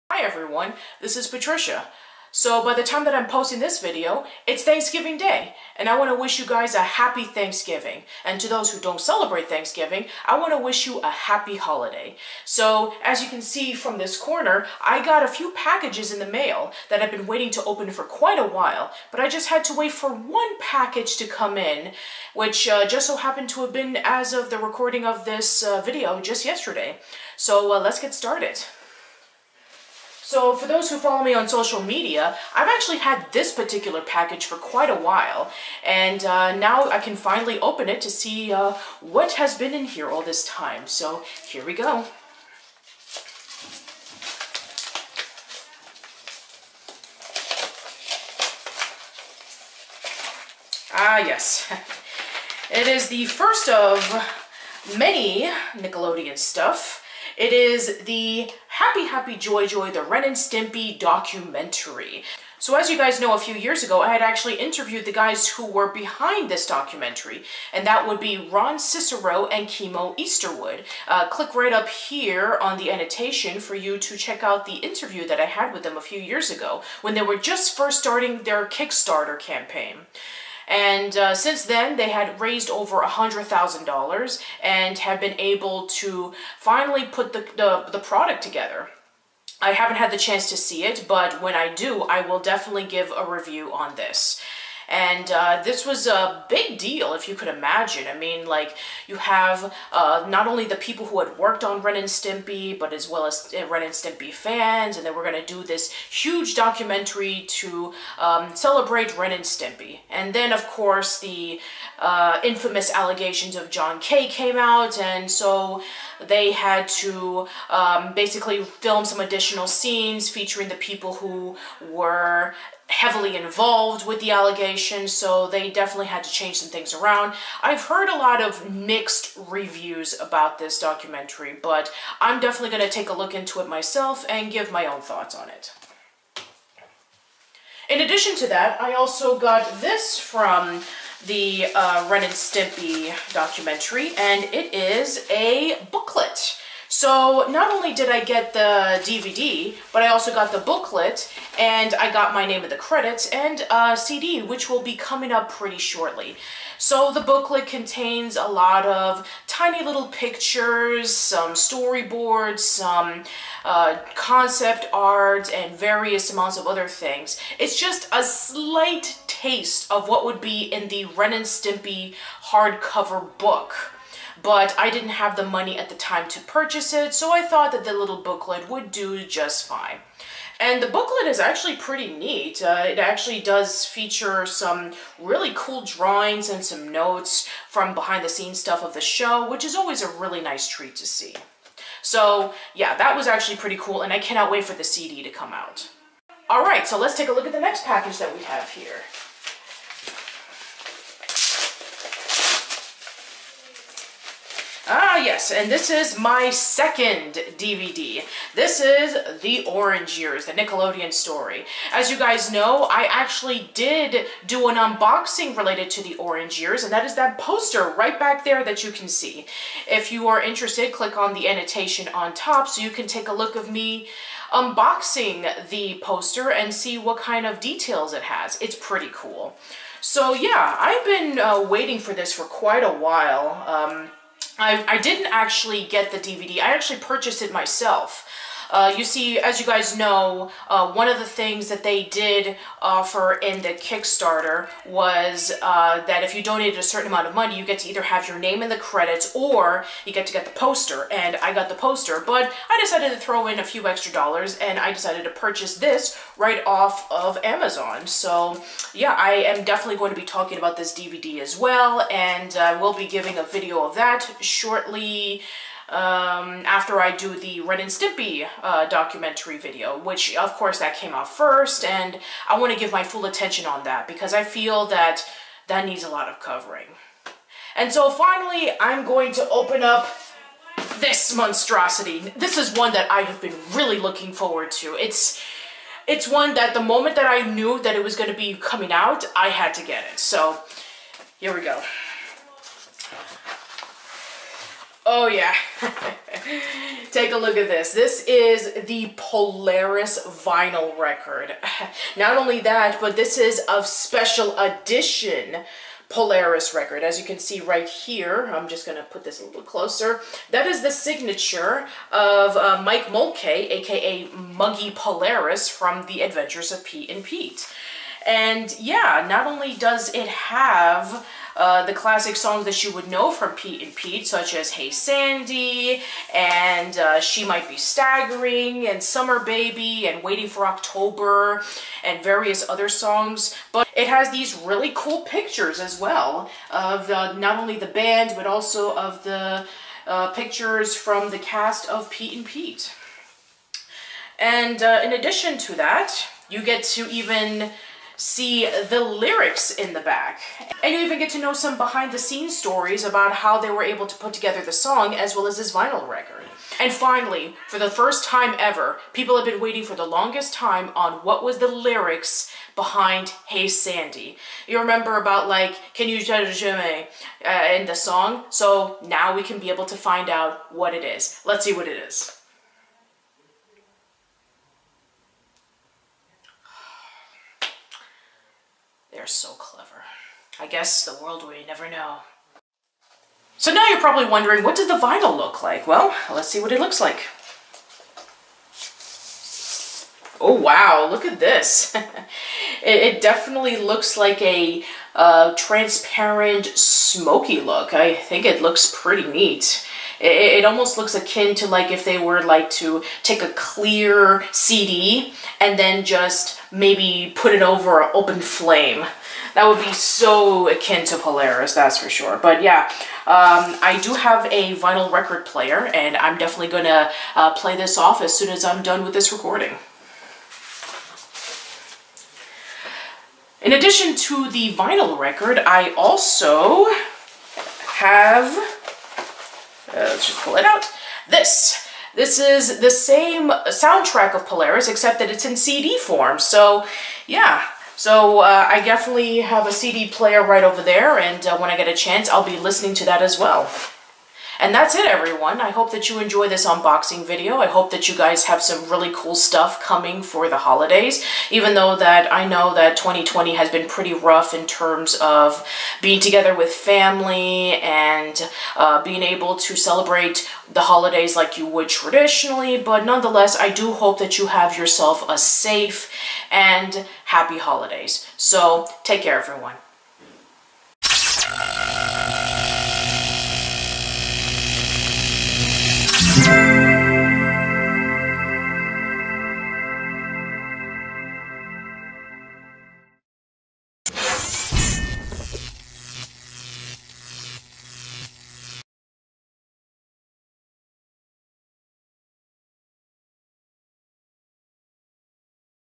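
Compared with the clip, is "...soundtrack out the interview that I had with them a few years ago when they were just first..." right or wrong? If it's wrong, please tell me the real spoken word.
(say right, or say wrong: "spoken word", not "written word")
wrong: "check", not "soundtrack".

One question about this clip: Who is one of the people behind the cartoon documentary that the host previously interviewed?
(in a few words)
Ron Cicero.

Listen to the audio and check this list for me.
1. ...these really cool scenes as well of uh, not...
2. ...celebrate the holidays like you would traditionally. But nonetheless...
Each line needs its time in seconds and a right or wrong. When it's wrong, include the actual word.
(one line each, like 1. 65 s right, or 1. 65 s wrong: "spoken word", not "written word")
1. 334 s wrong: "pictures", not "scenes"
2. 459 s right.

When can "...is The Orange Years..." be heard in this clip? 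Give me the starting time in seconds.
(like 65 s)
208 s.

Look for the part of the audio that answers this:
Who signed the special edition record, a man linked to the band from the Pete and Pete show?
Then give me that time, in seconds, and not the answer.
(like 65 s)
312 s.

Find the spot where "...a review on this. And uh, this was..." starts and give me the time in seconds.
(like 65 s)
93 s.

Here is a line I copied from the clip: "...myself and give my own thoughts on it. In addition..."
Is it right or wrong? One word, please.
right.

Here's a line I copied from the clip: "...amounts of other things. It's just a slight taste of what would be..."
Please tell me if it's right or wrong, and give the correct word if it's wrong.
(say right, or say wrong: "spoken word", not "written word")
right.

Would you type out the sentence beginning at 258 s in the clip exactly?
So yeah, I am definitely going to be talking about this DVD as well.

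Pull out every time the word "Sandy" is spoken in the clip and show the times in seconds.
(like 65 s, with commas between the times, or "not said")
324 s, 363 s.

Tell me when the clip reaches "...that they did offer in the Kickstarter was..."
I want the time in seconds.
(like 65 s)
241 s.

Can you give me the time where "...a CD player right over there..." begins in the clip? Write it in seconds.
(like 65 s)
439 s.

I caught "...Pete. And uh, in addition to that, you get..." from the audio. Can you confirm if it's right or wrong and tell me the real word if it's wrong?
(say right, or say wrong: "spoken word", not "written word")
right.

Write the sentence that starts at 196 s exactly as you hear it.
All right, so let's take a look at the next package that we have here.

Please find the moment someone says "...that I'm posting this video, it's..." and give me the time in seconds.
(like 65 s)
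3 s.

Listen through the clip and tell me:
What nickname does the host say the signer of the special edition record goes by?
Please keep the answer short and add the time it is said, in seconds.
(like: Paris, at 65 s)
Muggy Polaris, at 314 s.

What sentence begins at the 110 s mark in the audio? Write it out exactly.
And then, of course, the uh, infamous allegations of John K.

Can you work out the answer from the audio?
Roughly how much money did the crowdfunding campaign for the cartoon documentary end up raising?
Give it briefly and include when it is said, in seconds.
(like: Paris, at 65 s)
over $100,000, at 82 s.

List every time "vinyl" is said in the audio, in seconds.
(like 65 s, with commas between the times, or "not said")
300 s, 355 s, 384 s, 414 s, 424 s.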